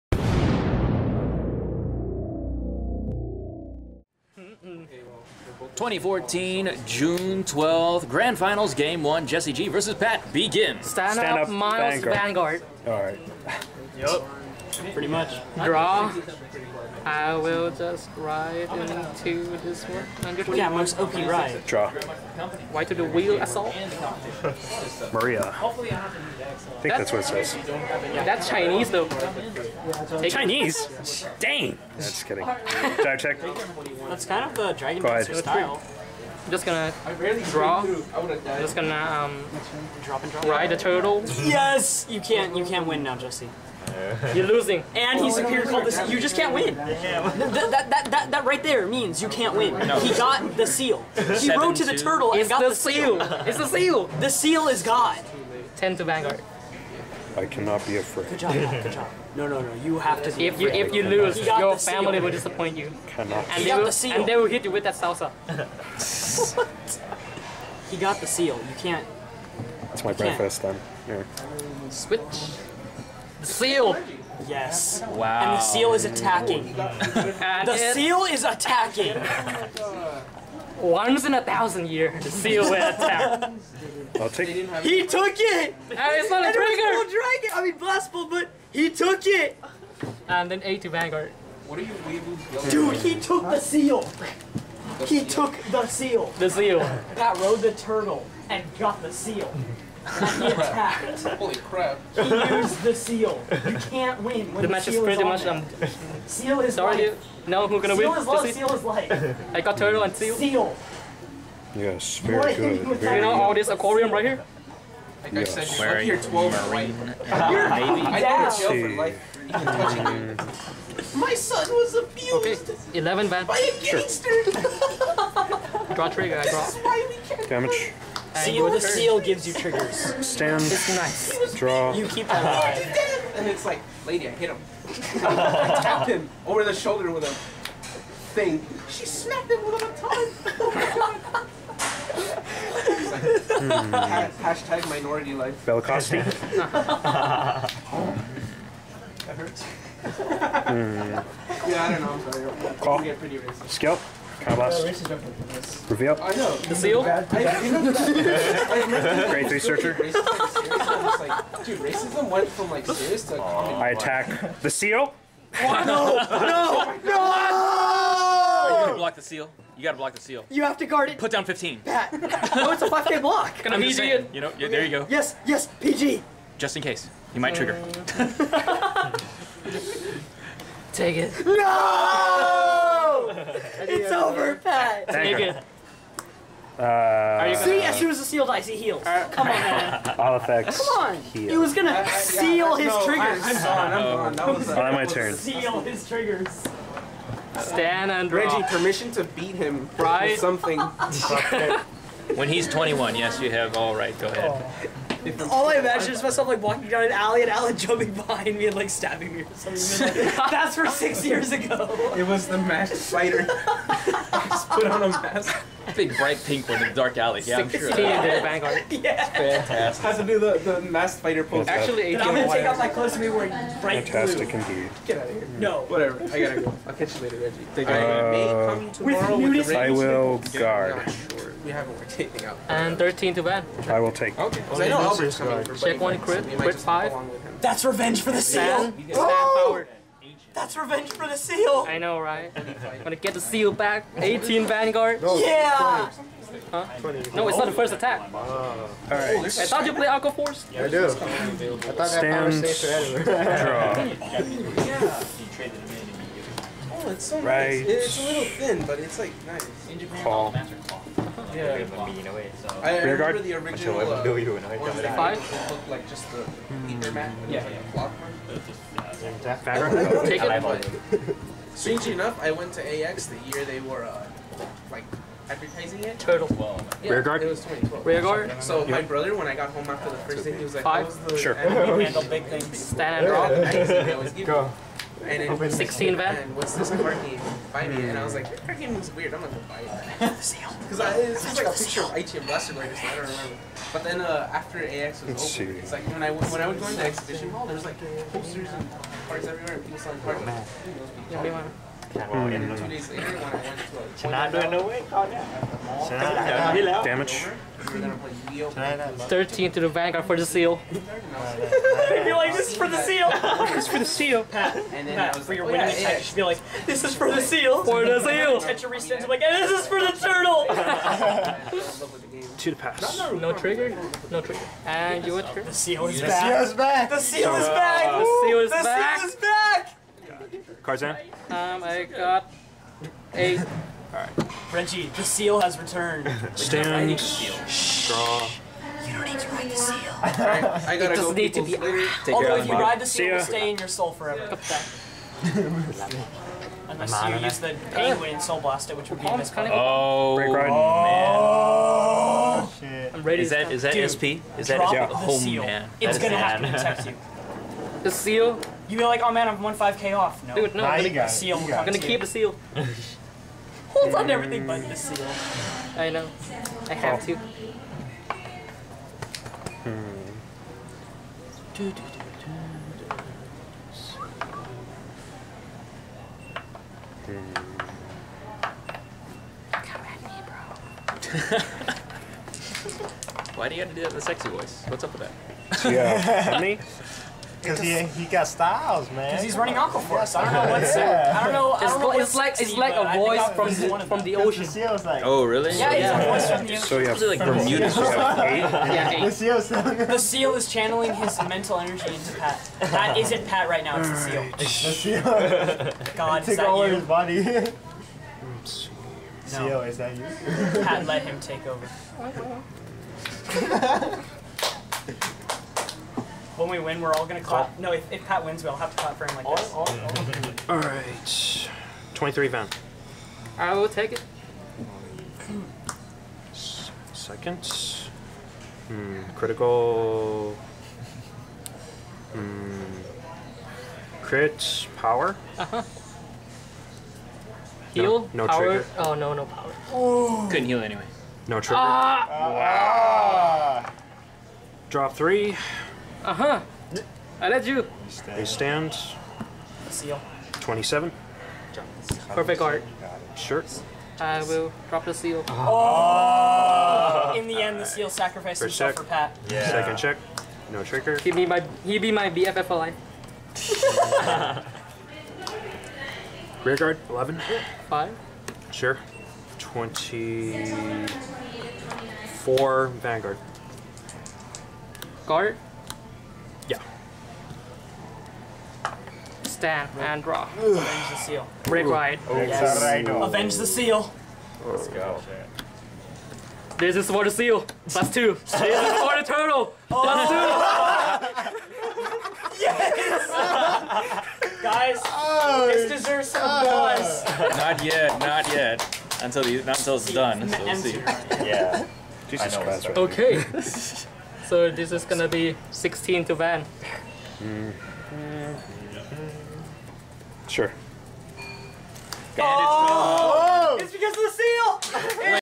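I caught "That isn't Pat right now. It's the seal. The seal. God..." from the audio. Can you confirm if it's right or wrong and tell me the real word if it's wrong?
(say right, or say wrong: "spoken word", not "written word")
right.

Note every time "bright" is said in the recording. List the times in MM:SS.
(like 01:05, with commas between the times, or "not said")
03:36, 03:43.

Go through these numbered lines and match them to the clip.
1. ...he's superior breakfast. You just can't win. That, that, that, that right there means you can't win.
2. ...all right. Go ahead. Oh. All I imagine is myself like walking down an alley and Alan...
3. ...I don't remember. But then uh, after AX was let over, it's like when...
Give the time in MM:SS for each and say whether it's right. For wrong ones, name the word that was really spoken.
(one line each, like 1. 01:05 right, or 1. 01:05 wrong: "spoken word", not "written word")
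1. 00:45 wrong: "cultist", not "breakfast"
2. 03:23 right
3. 04:53 right.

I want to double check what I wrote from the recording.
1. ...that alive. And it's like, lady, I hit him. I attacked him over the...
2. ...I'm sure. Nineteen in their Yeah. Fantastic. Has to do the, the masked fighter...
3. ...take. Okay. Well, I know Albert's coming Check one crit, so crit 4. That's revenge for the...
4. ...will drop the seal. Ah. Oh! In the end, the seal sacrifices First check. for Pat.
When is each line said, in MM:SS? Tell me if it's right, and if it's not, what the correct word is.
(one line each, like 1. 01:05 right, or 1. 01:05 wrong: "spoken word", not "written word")
1. 02:12 wrong: "tapped", not "attacked"
2. 03:37 wrong: "Sixteen", not "Nineteen"
3. 03:54 wrong: "5", not "4"
4. 07:34 right.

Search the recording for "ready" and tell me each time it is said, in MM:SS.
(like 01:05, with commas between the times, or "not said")
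05:53.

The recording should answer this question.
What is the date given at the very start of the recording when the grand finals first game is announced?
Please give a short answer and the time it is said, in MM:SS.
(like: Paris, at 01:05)
June 12th, 2014, at 00:05.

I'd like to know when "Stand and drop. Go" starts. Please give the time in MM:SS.
04:42.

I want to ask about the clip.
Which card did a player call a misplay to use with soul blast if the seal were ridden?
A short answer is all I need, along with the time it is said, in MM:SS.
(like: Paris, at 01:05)
the penguin, at 05:47.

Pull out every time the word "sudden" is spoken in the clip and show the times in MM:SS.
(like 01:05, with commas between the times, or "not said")
not said.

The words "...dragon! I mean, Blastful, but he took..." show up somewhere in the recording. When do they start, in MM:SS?
01:27.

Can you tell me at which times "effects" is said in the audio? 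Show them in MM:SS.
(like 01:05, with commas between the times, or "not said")
03:10.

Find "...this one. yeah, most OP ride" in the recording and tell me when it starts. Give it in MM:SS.
00:19.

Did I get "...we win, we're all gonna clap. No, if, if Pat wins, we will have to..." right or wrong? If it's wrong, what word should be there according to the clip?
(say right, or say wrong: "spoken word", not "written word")
right.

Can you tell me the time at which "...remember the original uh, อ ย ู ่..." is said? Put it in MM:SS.
04:23.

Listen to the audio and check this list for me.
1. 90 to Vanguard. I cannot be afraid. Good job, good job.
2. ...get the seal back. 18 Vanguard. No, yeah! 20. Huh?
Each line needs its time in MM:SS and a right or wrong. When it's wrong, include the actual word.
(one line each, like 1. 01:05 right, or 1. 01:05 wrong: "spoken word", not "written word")
1. 00:55 wrong: "10", not "90"
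2. 04:03 right.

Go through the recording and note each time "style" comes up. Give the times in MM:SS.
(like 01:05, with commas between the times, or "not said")
00:35, 06:28.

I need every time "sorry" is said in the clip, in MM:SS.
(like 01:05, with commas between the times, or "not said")
01:46, 02:32.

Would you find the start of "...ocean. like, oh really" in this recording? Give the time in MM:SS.
06:34.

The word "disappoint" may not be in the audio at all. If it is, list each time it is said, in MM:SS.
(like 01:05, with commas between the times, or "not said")
01:02.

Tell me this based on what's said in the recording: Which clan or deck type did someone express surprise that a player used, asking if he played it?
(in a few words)
Aqua Force.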